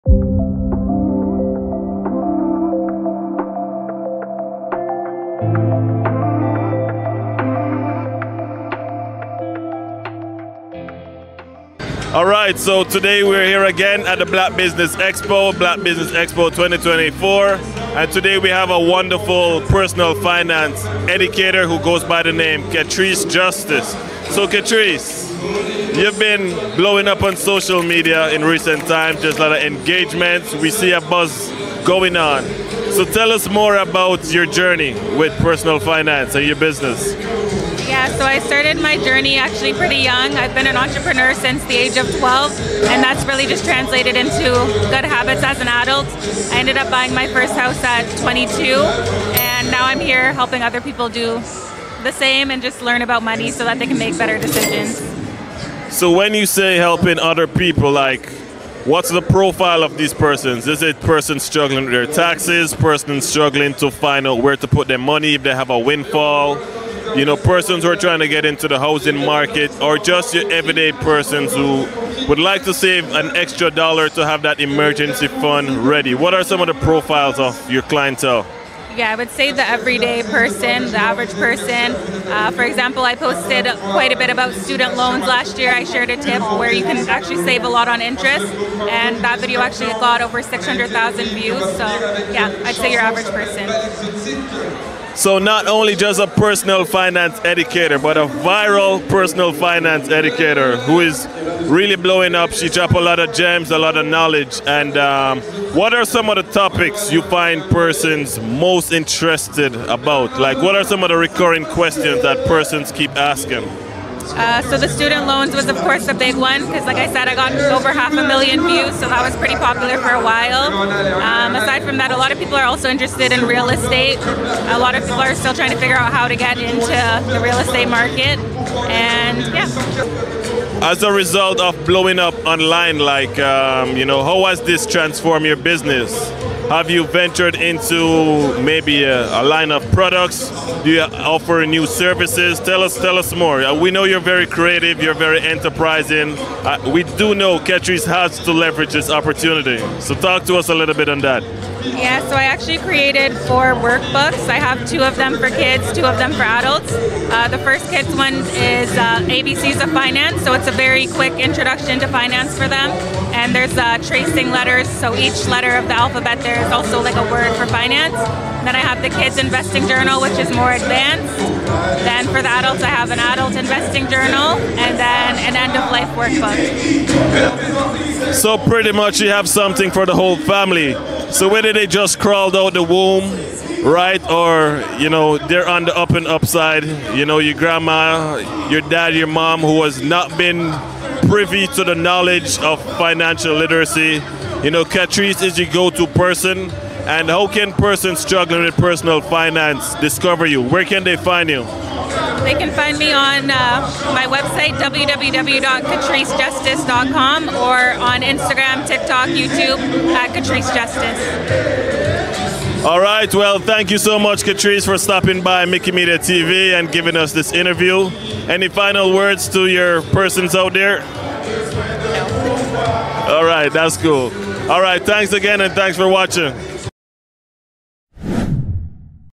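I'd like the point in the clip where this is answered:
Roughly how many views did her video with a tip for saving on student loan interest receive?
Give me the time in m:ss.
1:30.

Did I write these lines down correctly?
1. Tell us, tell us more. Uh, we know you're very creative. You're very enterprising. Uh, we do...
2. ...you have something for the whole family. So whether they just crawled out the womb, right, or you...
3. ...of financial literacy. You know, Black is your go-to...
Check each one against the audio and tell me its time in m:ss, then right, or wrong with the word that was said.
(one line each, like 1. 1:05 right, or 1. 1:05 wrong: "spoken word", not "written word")
1. 2:22 right
2. 2:59 right
3. 3:12 wrong: "Katrice", not "Black".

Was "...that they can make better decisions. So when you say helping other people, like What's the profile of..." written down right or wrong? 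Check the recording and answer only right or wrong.
right.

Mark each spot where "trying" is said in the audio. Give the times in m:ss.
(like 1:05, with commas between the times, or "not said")
1:07, 2:05.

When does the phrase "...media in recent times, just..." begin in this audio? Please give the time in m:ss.
0:27.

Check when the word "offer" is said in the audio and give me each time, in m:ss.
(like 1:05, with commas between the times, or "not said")
2:21.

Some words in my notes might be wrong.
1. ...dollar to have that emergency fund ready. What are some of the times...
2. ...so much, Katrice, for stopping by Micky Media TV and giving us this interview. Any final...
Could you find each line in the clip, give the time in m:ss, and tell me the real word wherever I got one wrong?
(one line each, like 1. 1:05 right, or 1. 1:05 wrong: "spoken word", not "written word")
1. 1:13 wrong: "profiles", not "times"
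2. 3:33 right.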